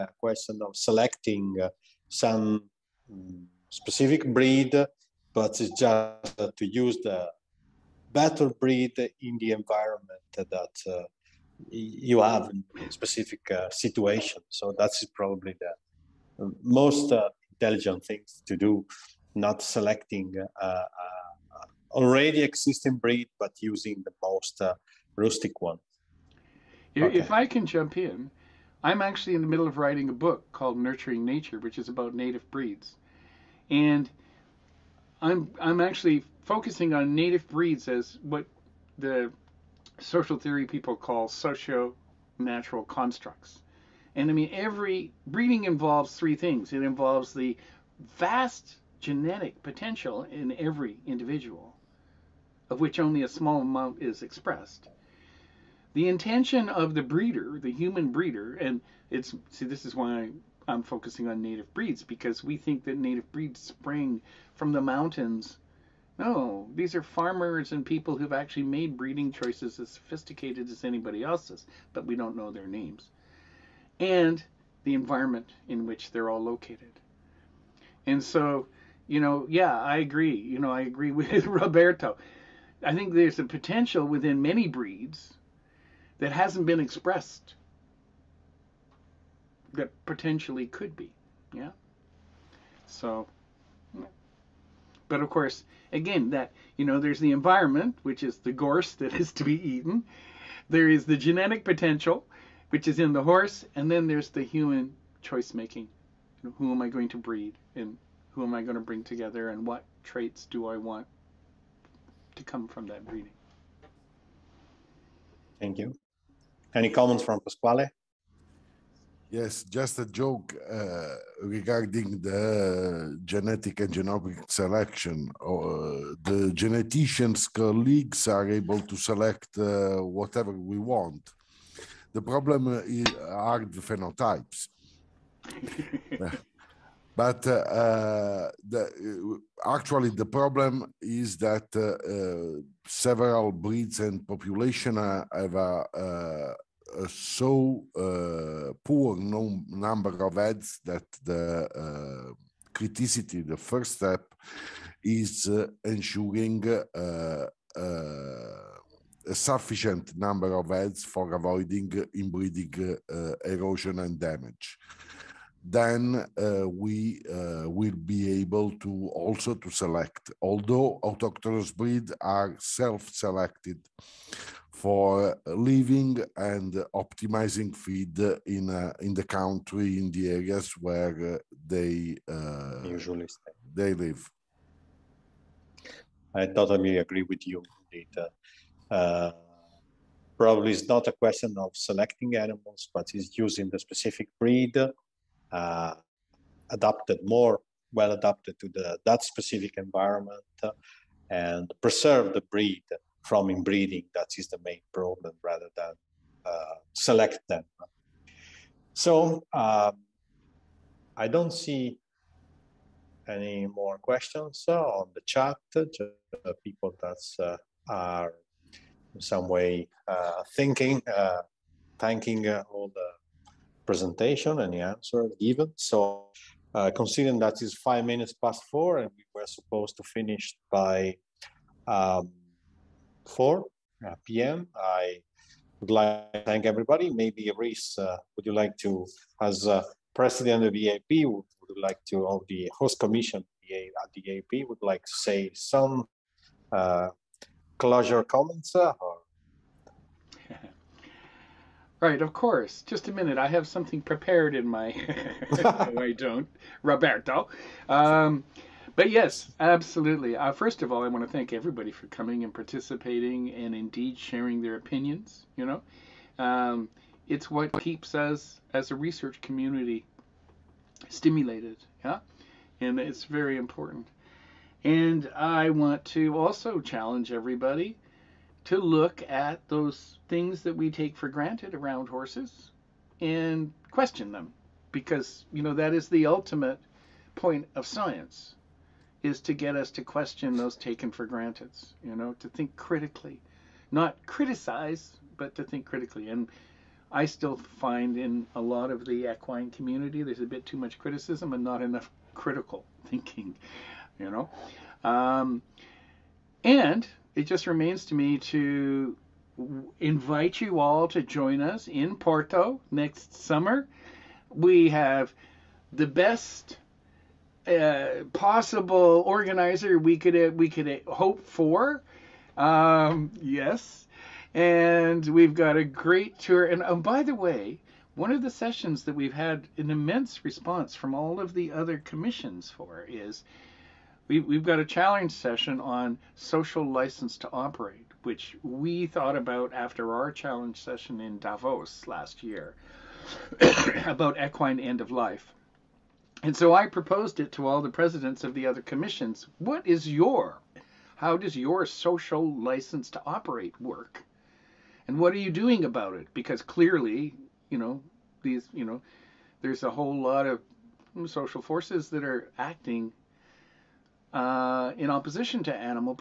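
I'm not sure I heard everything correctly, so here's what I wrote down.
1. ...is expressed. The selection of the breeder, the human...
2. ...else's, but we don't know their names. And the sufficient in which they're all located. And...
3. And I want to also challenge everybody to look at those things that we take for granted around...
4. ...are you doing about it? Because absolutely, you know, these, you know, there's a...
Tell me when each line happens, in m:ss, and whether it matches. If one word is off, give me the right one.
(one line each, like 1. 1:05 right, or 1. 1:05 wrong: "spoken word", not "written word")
1. 0:54 wrong: "intention", not "selection"
2. 1:11 wrong: "environment", not "sufficient"
3. 4:34 right
4. 5:55 wrong: "clearly", not "absolutely".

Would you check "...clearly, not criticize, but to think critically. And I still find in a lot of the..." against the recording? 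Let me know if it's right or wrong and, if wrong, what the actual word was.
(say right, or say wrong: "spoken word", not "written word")
wrong: "critically", not "clearly".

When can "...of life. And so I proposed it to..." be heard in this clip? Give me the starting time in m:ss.
5:45.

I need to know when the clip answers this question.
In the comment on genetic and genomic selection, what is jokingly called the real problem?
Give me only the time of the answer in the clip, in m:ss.
2:13.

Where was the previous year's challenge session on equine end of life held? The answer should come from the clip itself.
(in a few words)
Davos.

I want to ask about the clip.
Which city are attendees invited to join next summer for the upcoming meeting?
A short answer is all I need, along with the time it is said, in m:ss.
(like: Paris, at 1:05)
Porto, at 5:12.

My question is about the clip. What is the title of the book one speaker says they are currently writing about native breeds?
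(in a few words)
Nurturing Nature.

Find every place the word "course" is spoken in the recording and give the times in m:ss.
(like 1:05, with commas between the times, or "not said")
1:35, 4:12.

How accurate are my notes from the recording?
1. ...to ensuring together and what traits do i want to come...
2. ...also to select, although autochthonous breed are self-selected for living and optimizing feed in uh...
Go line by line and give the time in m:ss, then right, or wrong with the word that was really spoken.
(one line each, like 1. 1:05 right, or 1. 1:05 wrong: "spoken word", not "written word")
1. 1:48 wrong: "bring", not "ensuring"
2. 2:49 right.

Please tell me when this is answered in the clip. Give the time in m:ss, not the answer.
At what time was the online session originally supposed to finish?
3:53.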